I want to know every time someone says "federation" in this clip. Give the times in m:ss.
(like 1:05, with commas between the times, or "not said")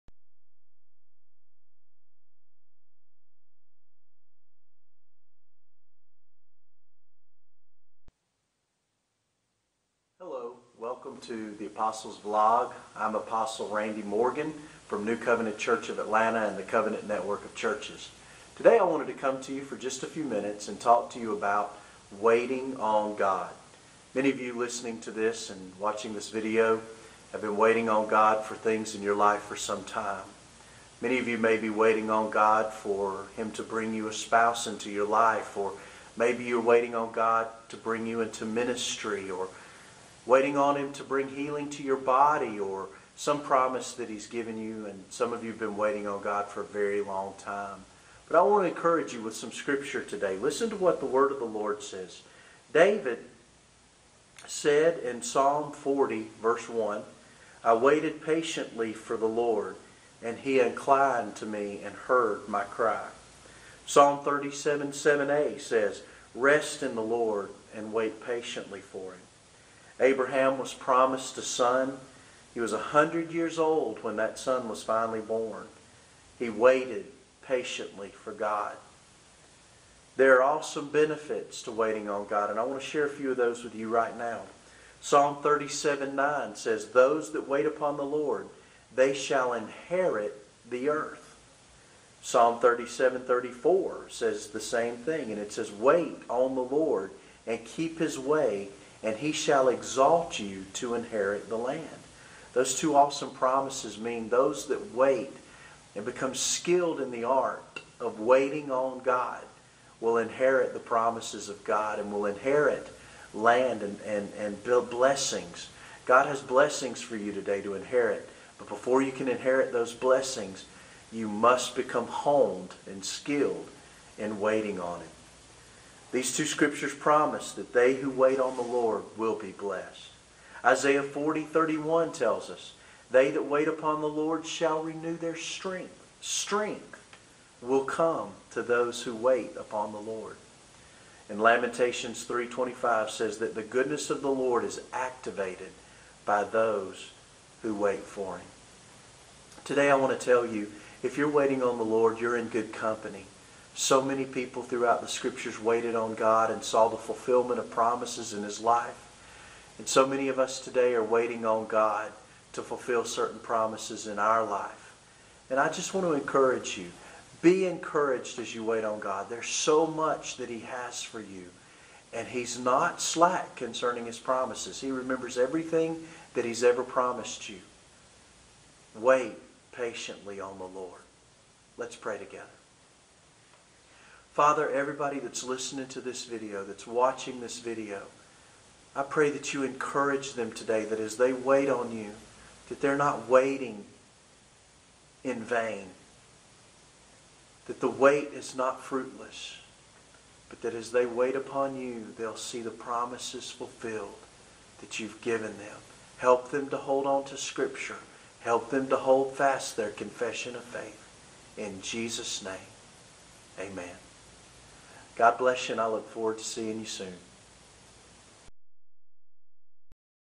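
not said.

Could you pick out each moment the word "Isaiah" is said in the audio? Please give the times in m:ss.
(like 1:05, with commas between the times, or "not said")
2:10.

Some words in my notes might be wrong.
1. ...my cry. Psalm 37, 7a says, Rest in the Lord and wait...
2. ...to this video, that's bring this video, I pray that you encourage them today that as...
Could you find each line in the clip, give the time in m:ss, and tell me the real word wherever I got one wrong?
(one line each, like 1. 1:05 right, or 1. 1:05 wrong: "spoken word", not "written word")
1. 1:02 right
2. 3:05 wrong: "watching", not "bring".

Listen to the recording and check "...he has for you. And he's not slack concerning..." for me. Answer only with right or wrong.
right.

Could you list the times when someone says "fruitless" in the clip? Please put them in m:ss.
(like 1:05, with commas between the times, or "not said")
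3:18.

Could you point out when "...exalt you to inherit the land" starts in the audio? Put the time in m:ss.
1:39.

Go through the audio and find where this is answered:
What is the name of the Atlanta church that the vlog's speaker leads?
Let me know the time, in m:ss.
0:15.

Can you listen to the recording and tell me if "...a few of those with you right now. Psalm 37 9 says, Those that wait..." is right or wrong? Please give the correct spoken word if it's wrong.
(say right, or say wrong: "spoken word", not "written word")
right.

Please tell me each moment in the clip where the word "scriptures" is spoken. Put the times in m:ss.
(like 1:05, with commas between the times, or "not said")
0:49, 2:06, 2:35, 3:27.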